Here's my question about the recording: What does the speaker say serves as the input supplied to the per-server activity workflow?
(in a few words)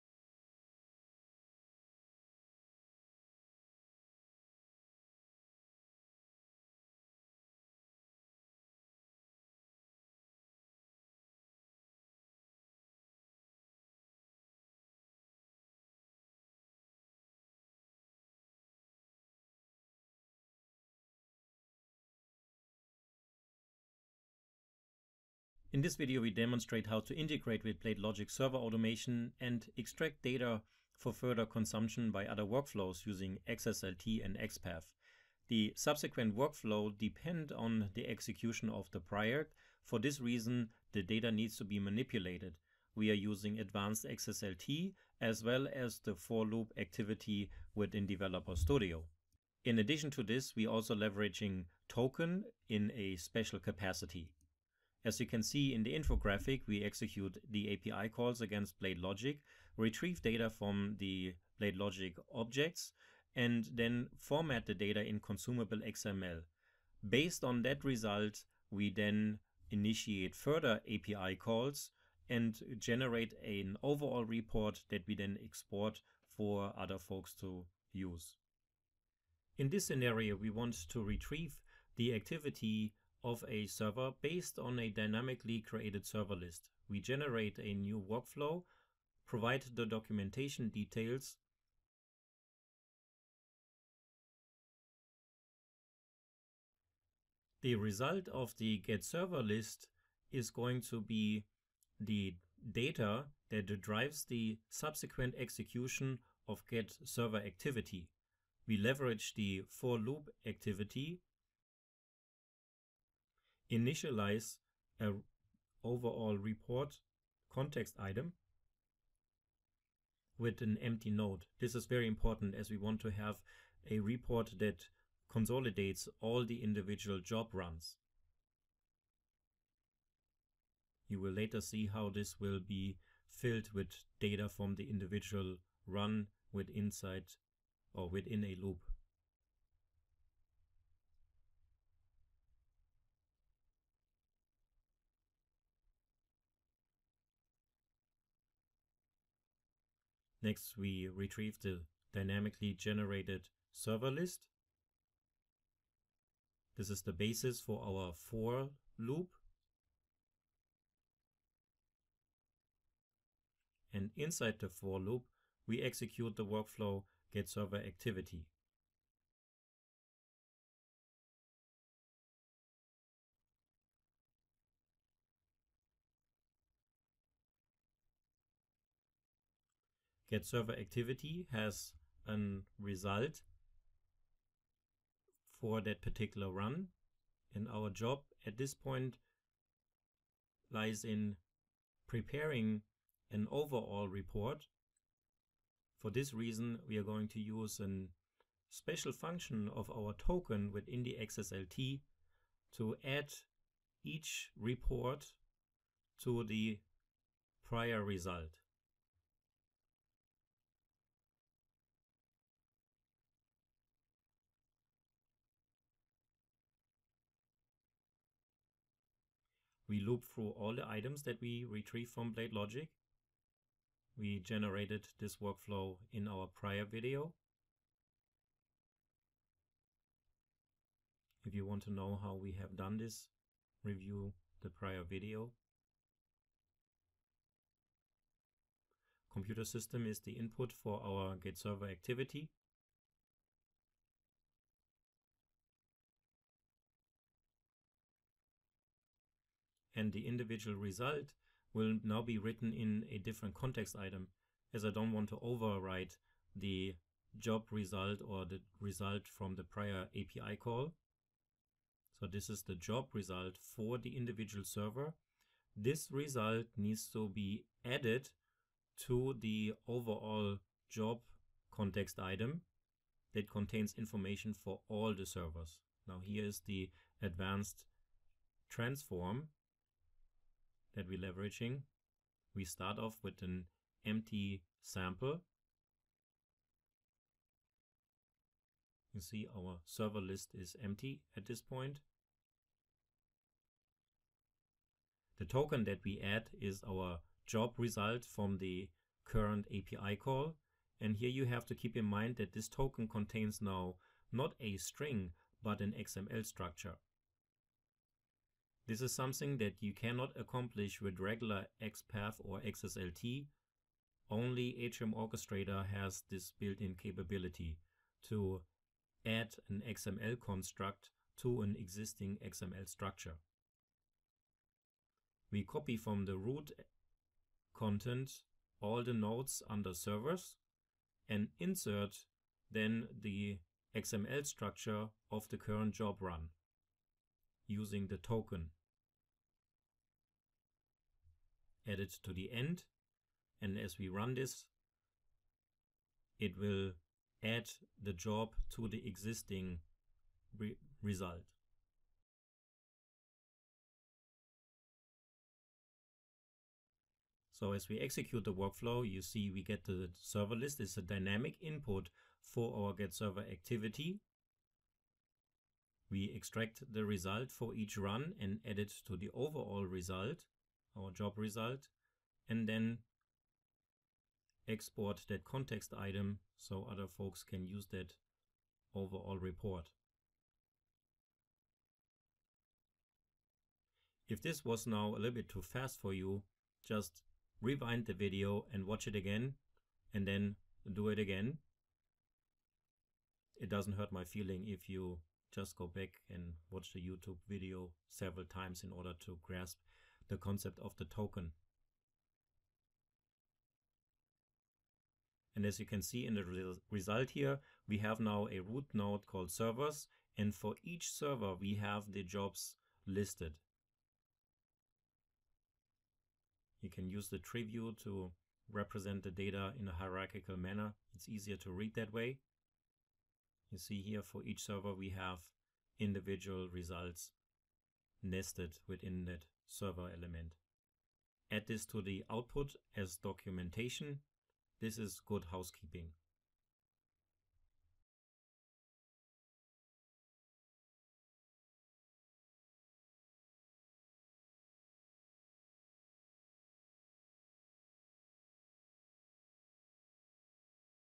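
Computer system.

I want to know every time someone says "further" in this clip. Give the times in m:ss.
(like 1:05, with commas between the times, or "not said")
0:31, 1:10.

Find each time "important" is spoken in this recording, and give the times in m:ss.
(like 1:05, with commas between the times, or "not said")
2:02.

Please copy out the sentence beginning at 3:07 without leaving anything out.
And our job at this point lies in preparing an overall report.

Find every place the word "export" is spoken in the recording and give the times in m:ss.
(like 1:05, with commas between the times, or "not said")
1:15, 6:14.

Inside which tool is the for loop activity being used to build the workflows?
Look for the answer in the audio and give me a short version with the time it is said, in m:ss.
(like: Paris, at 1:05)
Developer Studio, at 0:48.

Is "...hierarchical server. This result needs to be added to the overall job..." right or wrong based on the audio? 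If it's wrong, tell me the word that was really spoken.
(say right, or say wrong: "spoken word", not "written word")
wrong: "individual", not "hierarchical".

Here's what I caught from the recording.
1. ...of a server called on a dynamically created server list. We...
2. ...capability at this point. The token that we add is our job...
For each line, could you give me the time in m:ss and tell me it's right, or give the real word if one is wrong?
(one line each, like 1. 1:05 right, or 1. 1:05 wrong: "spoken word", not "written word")
1. 1:23 wrong: "based", not "called"
2. 4:50 wrong: "empty", not "capability".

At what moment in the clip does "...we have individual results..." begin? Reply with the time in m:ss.
7:04.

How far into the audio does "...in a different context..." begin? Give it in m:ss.
4:12.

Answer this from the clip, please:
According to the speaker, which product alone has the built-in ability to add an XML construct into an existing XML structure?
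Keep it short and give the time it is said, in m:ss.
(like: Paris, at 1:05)
Atrium Orchestrator, at 5:14.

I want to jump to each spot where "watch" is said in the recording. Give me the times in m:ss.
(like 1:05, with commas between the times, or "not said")
6:28, 6:36.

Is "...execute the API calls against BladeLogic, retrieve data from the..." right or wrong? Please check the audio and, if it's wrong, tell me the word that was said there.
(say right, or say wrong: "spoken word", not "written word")
right.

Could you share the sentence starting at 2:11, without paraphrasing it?
You will later see how this will be filled with data from the individual run with inside or within a loop.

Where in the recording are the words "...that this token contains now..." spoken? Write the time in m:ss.
5:02.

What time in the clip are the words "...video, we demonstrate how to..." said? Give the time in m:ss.
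0:25.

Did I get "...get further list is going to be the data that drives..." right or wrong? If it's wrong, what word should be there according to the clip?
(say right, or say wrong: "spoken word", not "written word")
wrong: "server", not "further".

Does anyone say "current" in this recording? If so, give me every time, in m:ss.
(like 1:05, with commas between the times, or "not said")
4:59, 5:35.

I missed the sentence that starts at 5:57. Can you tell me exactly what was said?
So as we execute the workflow, you see we get the server list.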